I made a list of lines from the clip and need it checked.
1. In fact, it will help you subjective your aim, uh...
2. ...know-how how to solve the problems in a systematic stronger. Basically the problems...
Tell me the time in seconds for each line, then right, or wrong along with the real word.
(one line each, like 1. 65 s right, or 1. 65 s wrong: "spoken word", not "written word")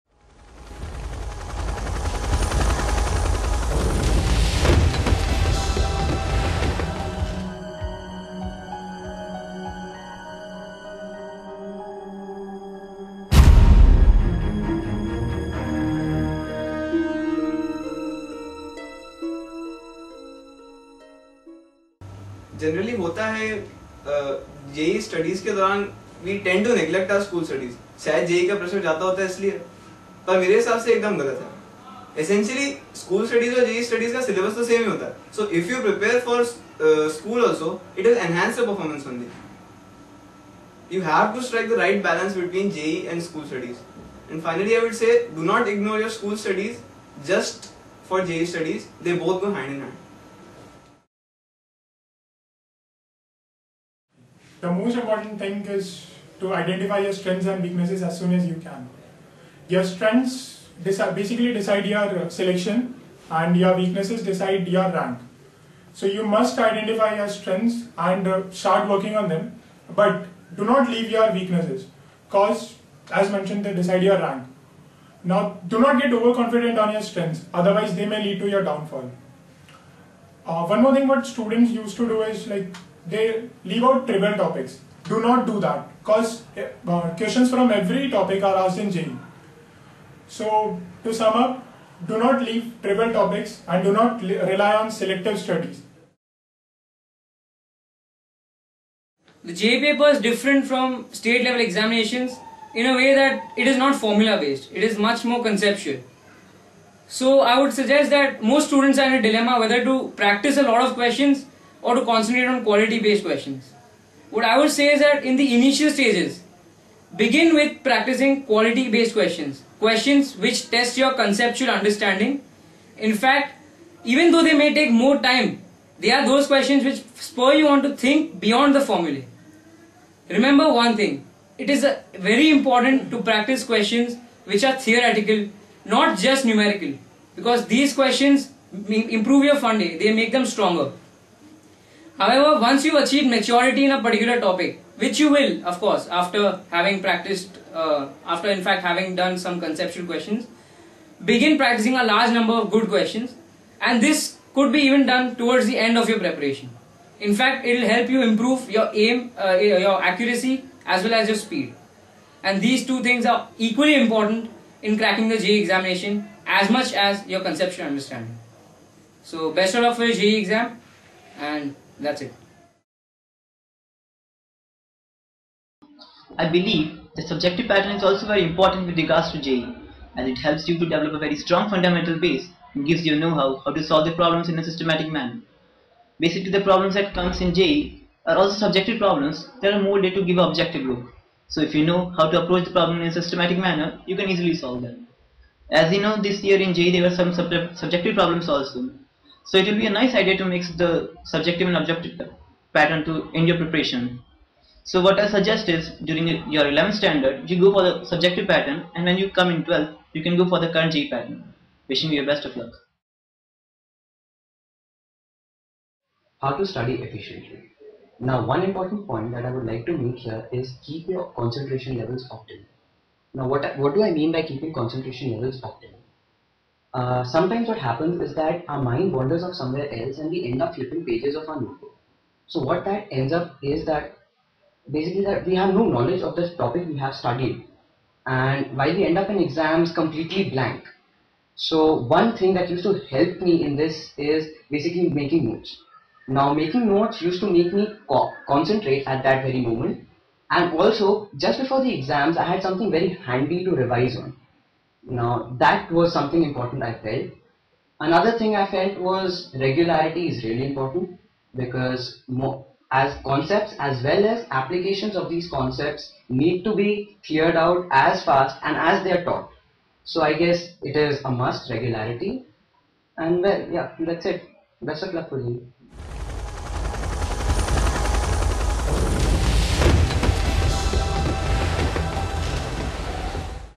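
1. 157 s wrong: "improve", not "subjective"
2. 183 s wrong: "manner", not "stronger".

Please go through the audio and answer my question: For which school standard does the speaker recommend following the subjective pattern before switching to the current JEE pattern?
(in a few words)
11th standard.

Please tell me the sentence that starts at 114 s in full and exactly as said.
What I would say is that in the initial stages, begin with practicing quality based questions, questions which test your conceptual understanding.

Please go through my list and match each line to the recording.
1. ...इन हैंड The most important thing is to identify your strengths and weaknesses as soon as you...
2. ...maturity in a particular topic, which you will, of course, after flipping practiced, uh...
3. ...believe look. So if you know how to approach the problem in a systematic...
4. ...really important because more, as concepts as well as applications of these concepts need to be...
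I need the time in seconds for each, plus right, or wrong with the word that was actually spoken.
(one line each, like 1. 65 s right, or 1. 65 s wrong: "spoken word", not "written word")
1. 49 s right
2. 143 s wrong: "having", not "flipping"
3. 190 s wrong: "objective", not "believe"
4. 260 s right.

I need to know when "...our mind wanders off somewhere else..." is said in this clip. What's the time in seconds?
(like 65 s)
228 s.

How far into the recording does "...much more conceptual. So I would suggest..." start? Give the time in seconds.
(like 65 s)
104 s.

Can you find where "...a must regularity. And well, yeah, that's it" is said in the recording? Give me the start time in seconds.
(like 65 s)
271 s.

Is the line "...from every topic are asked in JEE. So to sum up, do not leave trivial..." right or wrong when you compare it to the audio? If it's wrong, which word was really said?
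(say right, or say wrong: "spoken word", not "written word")
right.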